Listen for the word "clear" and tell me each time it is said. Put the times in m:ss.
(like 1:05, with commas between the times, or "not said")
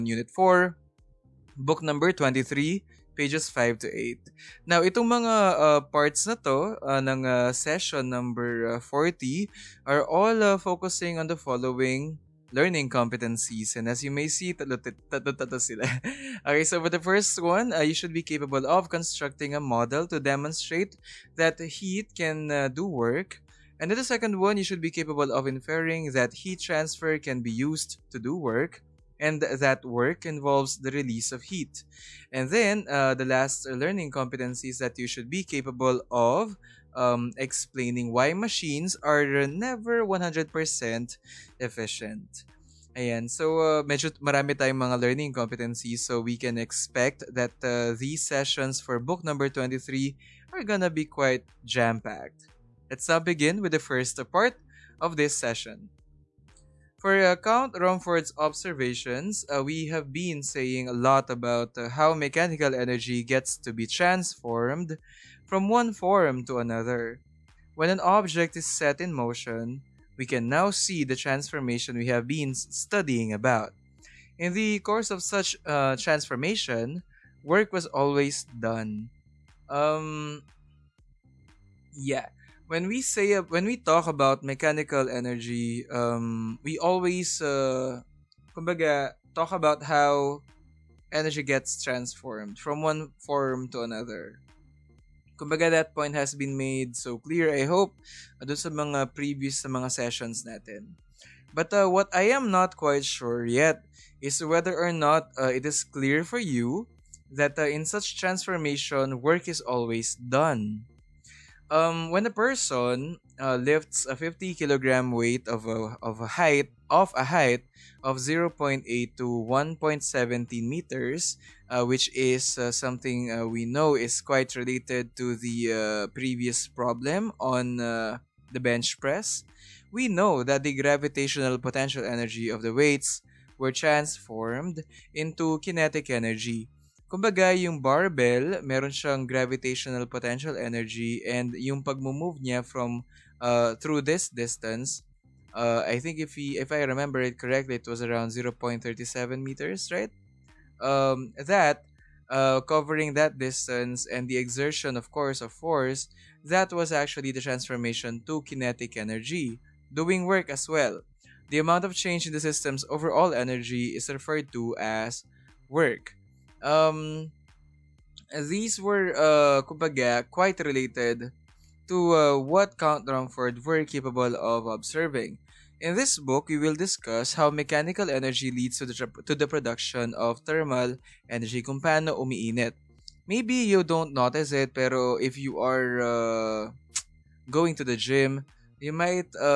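1:37, 1:45.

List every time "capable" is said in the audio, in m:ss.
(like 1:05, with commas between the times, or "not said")
0:18, 0:24, 0:35, 2:53.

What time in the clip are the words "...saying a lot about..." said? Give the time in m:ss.
1:00.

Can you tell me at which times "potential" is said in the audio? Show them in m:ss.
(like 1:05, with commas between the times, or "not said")
2:11, 2:20.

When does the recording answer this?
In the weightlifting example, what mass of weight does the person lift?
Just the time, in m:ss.
1:54.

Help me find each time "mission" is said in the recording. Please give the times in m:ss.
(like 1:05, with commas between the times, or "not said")
not said.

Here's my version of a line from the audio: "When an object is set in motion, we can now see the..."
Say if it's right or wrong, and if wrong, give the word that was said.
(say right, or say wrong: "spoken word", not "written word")
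right.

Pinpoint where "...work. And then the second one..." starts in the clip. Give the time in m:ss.
0:22.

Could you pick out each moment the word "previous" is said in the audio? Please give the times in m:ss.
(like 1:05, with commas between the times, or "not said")
1:39, 2:06.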